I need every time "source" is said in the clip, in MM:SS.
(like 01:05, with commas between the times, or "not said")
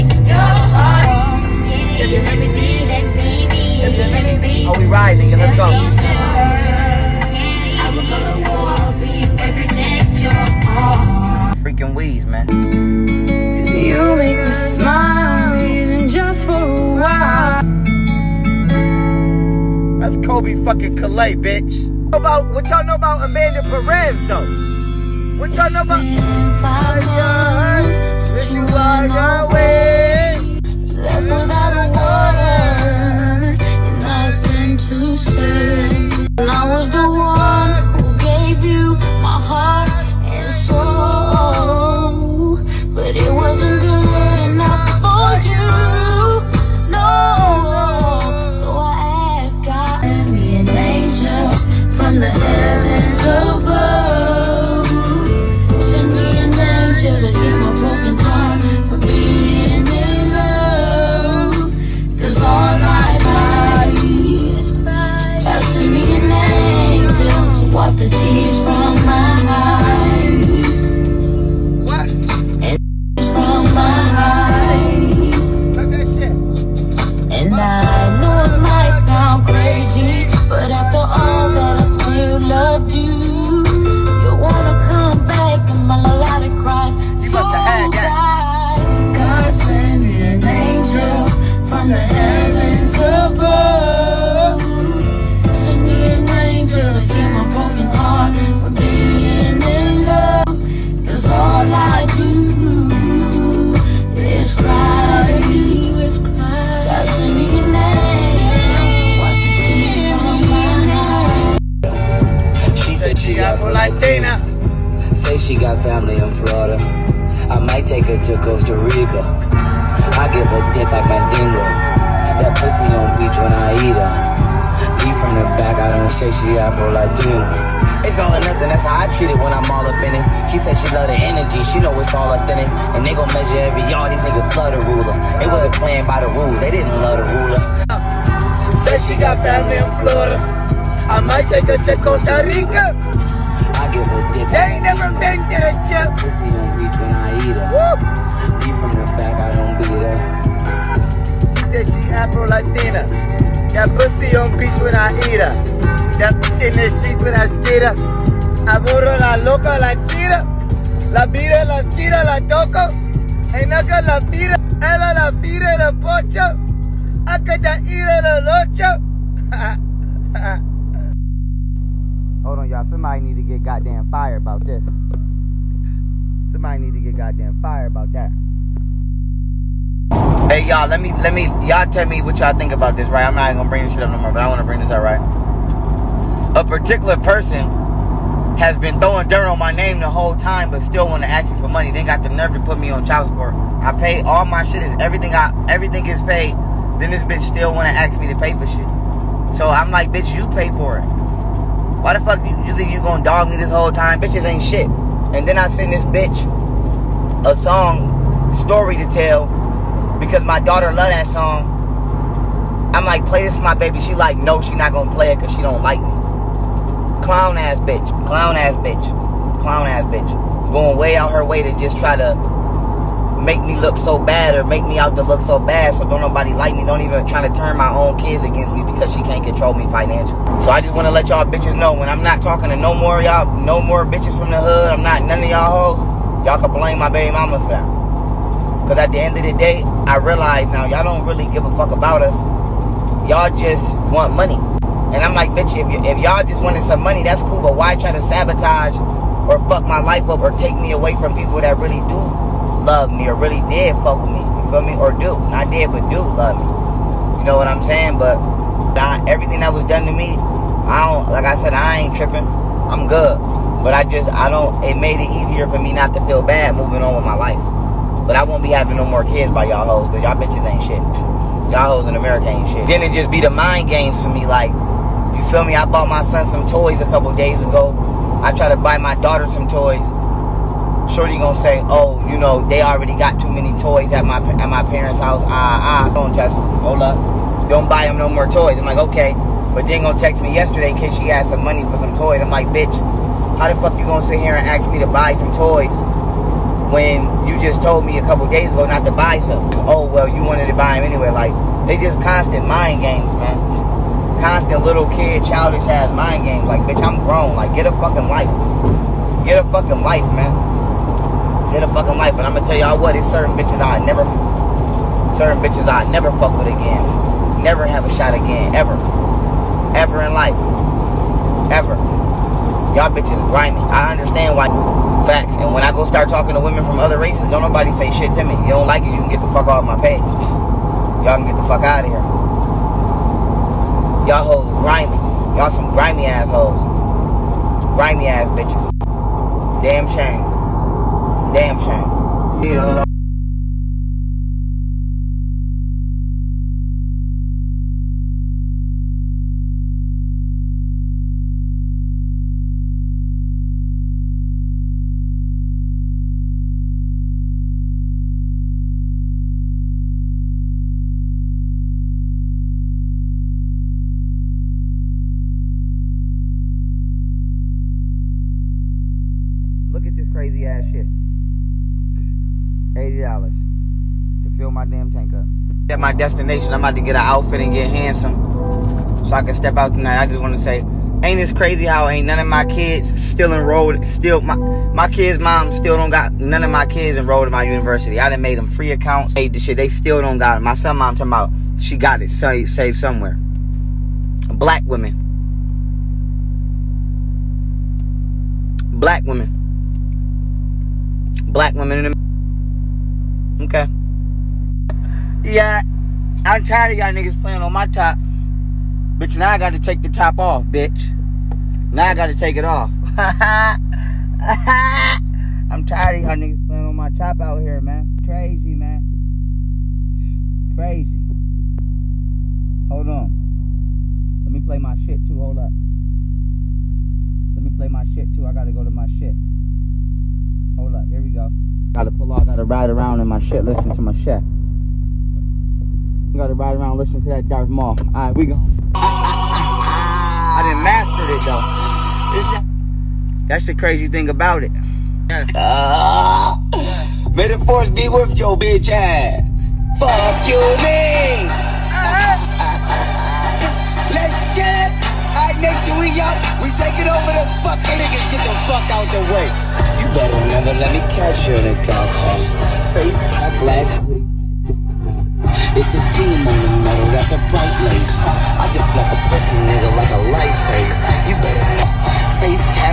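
not said.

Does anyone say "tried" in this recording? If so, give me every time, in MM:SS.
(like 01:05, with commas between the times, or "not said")
04:38.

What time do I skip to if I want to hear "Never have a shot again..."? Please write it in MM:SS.
05:17.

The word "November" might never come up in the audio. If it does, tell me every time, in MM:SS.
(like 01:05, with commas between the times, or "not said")
not said.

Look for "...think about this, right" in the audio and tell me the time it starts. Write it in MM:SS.
03:02.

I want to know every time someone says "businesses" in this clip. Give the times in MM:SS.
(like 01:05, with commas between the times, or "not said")
not said.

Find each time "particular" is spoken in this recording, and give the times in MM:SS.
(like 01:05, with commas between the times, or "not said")
03:06.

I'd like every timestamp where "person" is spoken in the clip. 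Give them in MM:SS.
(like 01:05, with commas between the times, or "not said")
03:07.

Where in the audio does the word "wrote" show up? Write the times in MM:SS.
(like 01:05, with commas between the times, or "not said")
not said.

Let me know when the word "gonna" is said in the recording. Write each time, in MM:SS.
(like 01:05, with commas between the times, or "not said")
03:03, 03:22, 03:34, 04:41, 04:50, 04:54, 05:12.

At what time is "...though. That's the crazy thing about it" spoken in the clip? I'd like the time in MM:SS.
07:21.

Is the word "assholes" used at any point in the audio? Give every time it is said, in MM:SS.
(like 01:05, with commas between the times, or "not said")
05:36.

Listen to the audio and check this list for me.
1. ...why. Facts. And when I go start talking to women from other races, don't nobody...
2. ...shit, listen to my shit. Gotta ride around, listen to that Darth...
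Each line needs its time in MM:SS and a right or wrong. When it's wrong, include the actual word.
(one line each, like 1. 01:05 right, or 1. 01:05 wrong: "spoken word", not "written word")
1. 05:24 right
2. 07:13 right.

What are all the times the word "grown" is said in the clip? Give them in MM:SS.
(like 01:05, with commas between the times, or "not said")
05:07.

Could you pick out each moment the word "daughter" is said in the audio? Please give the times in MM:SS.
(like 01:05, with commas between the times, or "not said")
03:30, 04:39.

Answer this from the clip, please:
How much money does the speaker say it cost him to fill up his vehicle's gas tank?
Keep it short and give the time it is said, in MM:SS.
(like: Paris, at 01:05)
$80, at 06:12.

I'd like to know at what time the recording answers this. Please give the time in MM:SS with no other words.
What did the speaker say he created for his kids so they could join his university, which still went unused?
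06:28.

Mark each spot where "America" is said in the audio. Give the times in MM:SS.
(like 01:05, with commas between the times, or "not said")
04:32, 06:42.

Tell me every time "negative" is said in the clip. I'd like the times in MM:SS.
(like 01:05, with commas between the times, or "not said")
not said.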